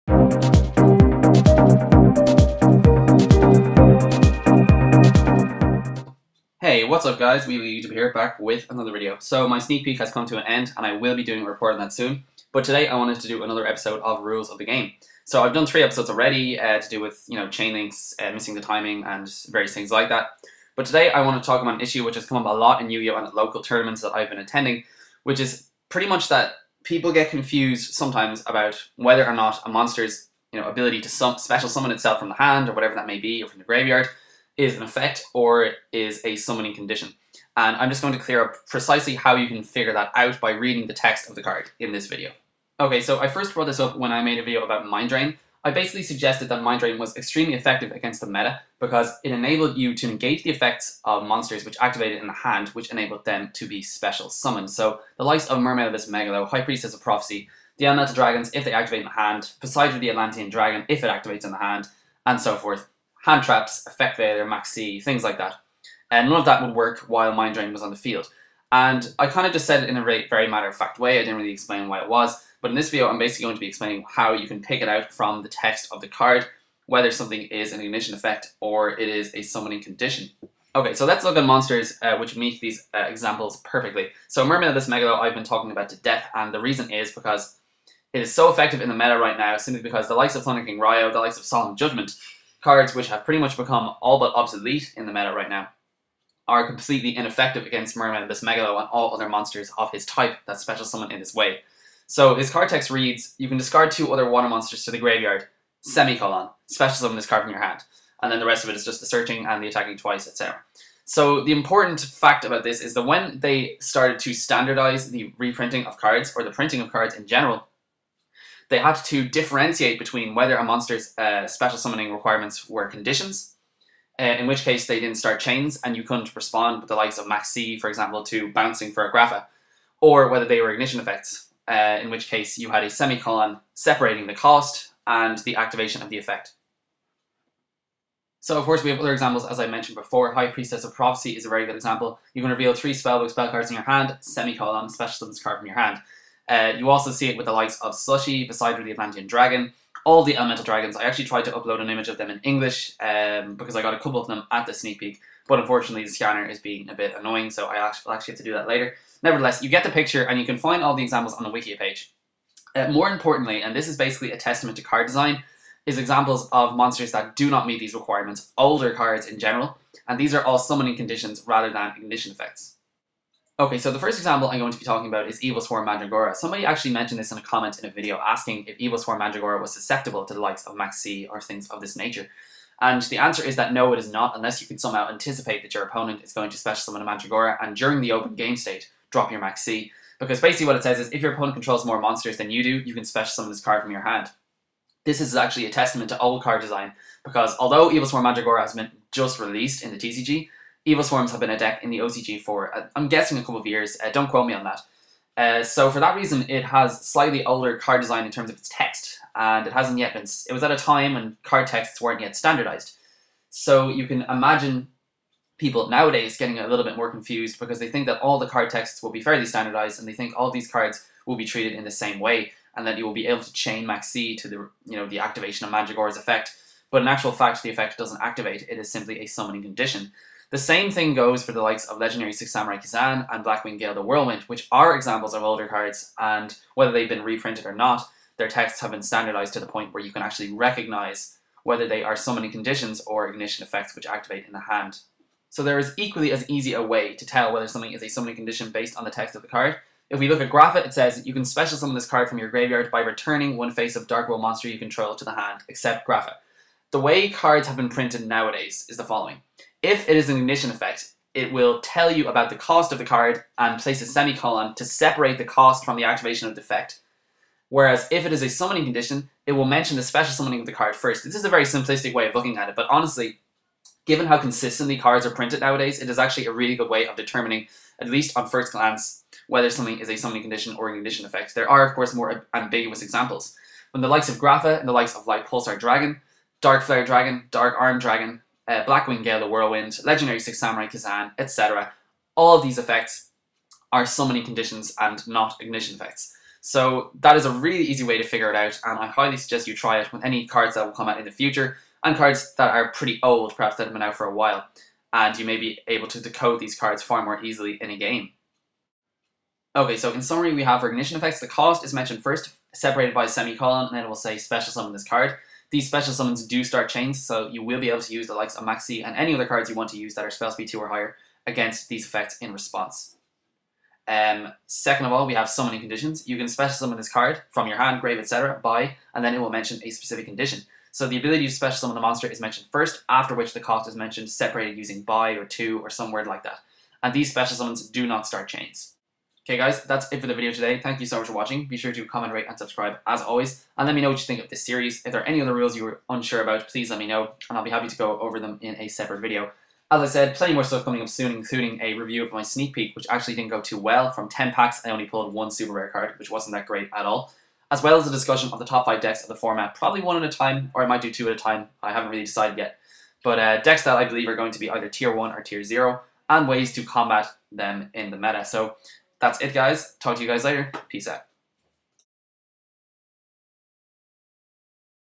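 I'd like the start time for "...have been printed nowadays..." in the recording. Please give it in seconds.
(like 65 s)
257 s.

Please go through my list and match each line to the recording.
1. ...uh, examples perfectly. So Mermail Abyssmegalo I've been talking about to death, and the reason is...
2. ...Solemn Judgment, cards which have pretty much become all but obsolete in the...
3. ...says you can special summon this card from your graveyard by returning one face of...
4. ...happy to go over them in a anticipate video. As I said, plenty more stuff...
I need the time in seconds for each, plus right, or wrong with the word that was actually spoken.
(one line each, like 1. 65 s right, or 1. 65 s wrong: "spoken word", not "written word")
1. 82 s right
2. 91 s right
3. 250 s right
4. 347 s wrong: "separate", not "anticipate".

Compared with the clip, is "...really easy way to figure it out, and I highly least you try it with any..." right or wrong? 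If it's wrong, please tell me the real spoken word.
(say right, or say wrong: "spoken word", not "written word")
wrong: "suggest", not "least".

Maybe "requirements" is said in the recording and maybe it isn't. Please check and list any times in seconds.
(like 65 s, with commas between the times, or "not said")
122 s, 167 s.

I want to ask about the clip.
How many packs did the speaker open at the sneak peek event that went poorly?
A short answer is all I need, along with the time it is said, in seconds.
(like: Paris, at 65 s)
10, at 354 s.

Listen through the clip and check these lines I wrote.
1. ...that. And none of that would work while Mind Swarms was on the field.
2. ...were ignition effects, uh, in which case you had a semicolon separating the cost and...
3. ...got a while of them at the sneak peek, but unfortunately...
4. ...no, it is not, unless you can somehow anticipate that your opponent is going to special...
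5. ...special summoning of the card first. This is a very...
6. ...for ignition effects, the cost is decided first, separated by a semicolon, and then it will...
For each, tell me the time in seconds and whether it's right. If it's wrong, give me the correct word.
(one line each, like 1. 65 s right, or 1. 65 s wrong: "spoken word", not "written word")
1. 65 s wrong: "Drain", not "Swarms"
2. 130 s right
3. 153 s wrong: "couple", not "while"
4. 183 s right
5. 270 s right
6. 310 s wrong: "mentioned", not "decided".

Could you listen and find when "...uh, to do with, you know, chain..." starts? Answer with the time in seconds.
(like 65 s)
16 s.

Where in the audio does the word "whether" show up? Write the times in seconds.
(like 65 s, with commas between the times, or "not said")
28 s, 76 s, 120 s, 130 s, 236 s, 241 s, 247 s, 279 s.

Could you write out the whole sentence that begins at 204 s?
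Uh, don't quote me on that.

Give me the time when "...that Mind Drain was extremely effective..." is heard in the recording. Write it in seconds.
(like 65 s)
46 s.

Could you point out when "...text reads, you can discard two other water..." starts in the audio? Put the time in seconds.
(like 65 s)
102 s.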